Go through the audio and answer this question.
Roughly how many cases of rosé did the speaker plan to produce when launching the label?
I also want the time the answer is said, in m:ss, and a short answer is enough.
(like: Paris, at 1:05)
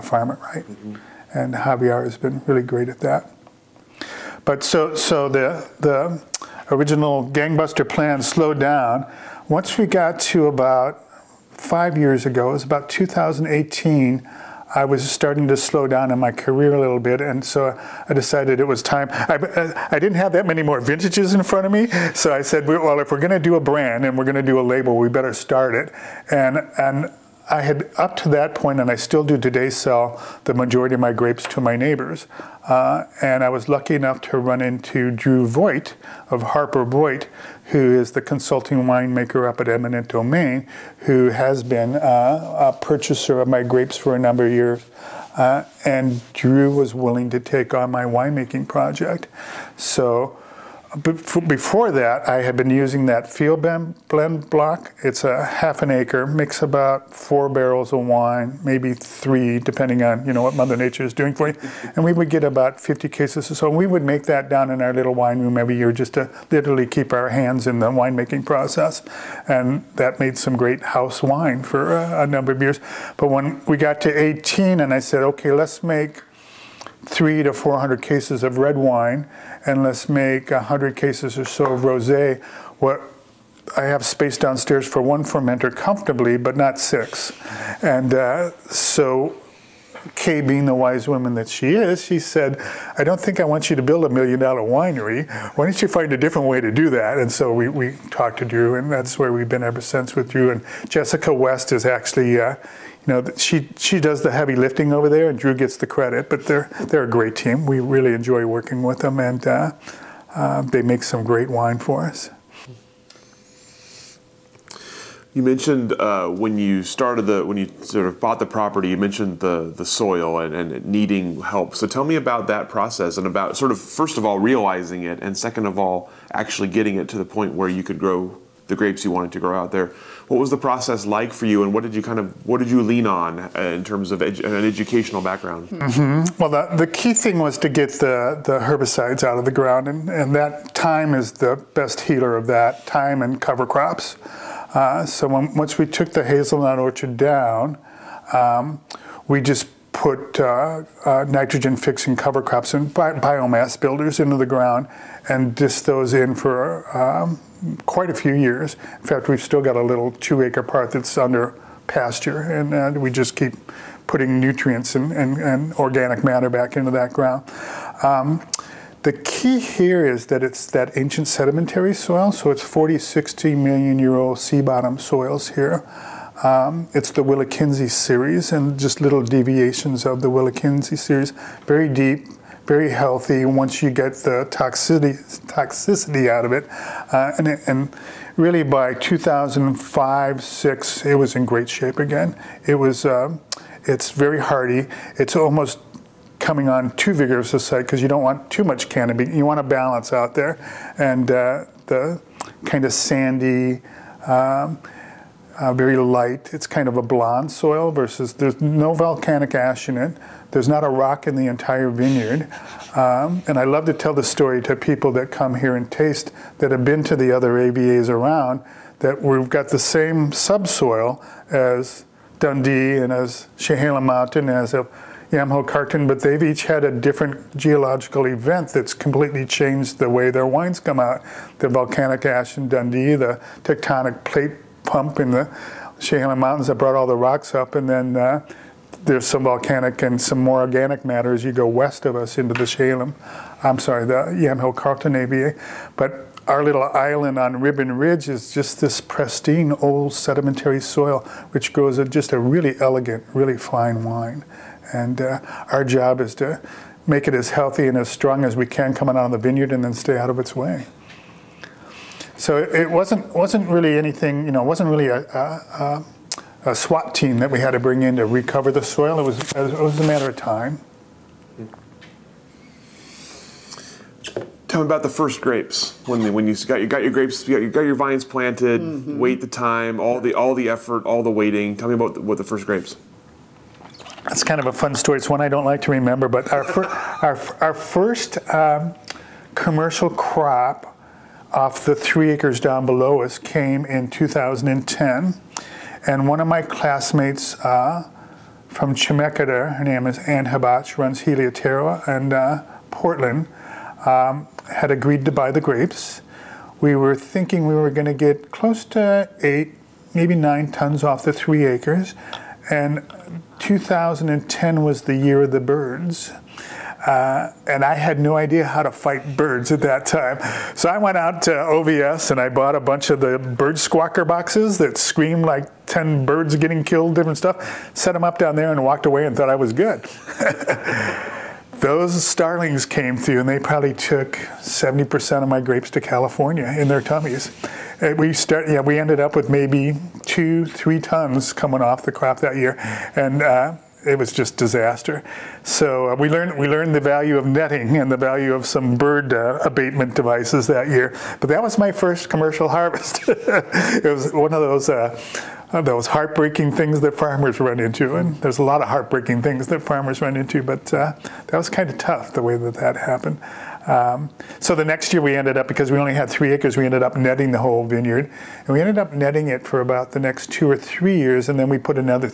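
100 cases, at 1:20.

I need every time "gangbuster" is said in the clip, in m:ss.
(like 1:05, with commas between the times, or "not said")
0:07.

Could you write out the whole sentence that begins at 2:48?
Um, the key here is that it's that ancient sedimentary soil, so it's 40, 60 million year old sea bottom soils here.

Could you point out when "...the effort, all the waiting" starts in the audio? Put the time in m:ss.
4:40.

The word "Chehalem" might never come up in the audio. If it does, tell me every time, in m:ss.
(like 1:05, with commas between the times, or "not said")
3:43, 3:55, 4:02.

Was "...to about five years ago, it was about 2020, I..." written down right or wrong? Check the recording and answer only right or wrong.
wrong.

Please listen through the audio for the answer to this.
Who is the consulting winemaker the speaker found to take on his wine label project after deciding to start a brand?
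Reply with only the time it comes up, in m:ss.
0:35.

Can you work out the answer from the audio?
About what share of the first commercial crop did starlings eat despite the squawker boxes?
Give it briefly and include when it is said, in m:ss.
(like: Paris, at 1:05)
70%, at 5:34.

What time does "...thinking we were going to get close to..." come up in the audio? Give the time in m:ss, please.
5:07.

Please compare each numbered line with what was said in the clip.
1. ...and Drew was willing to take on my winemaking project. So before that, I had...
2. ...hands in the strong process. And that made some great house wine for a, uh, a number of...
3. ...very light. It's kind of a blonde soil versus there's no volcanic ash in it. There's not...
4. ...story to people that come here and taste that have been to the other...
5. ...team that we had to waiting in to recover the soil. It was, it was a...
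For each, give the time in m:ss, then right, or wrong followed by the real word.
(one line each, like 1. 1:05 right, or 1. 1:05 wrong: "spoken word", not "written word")
1. 0:45 right
2. 1:07 wrong: "winemaking", not "strong"
3. 3:25 right
4. 3:34 right
5. 4:27 wrong: "bring", not "waiting".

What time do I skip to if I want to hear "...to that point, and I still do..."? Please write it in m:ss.
0:28.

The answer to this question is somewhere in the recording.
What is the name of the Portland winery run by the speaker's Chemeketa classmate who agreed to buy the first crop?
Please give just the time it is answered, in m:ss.
5:01.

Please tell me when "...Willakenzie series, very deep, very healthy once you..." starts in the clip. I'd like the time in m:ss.
3:00.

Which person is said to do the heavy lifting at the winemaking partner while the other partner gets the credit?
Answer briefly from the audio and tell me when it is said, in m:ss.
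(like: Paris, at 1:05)
Jessica West, at 1:40.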